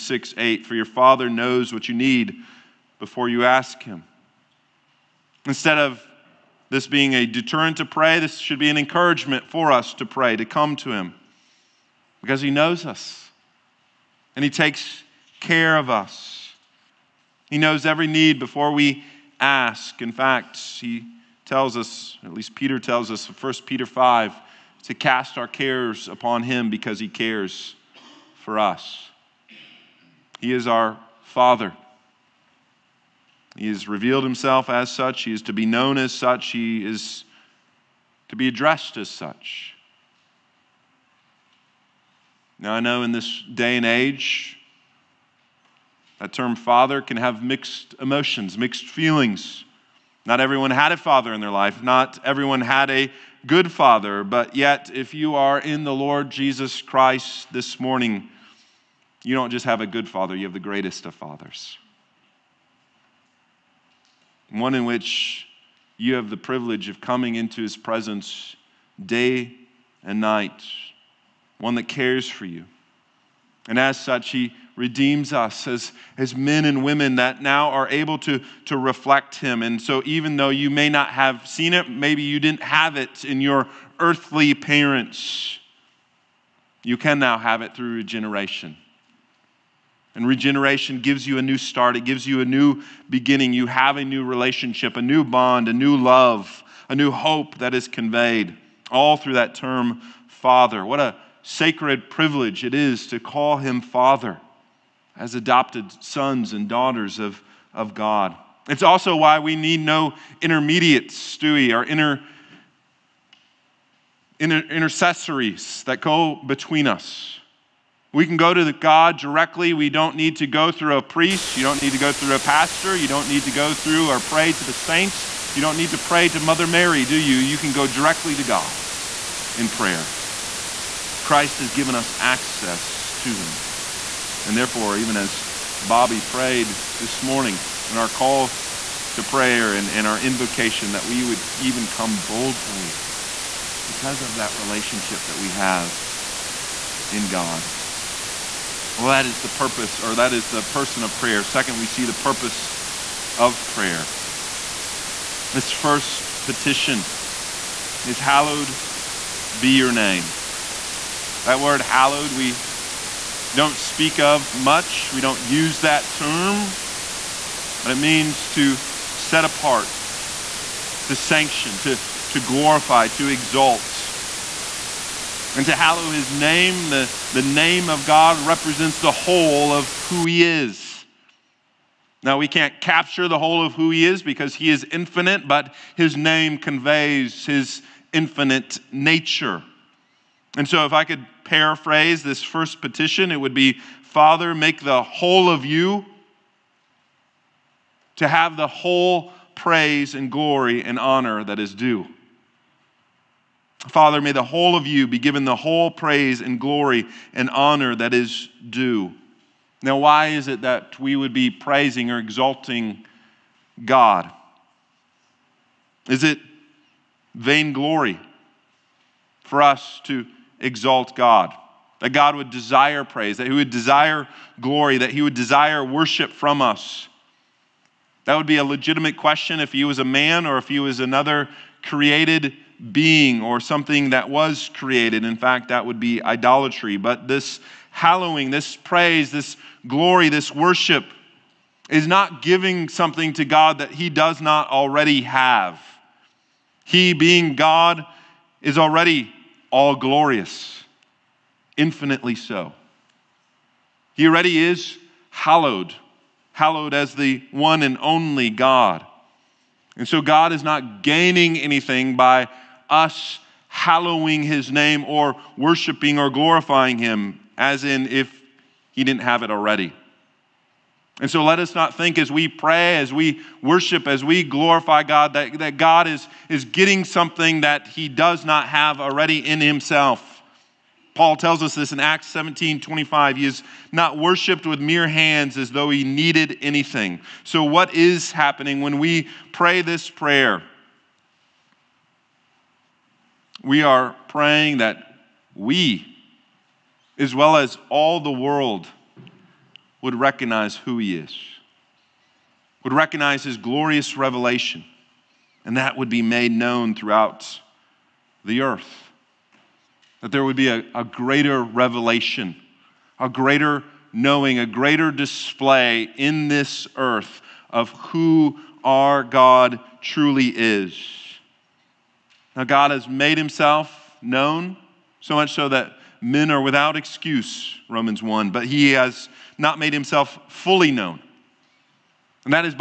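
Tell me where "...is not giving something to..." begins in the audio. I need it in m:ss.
4:01.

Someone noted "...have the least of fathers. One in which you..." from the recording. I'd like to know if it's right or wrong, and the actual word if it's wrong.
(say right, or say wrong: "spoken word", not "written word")
wrong: "greatest", not "least".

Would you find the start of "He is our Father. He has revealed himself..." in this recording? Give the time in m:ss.
0:30.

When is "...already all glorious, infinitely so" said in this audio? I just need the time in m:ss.
4:08.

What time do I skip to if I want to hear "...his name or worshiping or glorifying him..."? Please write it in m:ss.
4:24.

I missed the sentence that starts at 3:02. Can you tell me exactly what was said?
Now, we can't capture the whole of who he is because he is infinite, but his name conveys his infinite nature.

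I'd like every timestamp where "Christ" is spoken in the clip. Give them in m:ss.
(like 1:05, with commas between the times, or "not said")
0:56, 2:11.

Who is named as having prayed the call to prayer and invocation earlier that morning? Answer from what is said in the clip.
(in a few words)
Bobby.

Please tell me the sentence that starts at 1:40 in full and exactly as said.
What a sacred privilege it is to call him Father as adopted sons and daughters of, of God.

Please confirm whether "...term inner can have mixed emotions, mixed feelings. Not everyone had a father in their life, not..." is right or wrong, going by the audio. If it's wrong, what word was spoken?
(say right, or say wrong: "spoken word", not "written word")
wrong: "father", not "inner".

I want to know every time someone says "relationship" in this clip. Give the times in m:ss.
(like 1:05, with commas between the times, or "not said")
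1:34, 2:24.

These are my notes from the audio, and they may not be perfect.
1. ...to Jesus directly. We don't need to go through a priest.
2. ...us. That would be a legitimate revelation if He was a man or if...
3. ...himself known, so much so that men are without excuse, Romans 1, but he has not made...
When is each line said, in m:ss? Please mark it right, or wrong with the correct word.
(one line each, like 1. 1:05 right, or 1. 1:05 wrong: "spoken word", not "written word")
1. 1:58 wrong: "God", not "Jesus"
2. 3:46 wrong: "question", not "revelation"
3. 5:23 right.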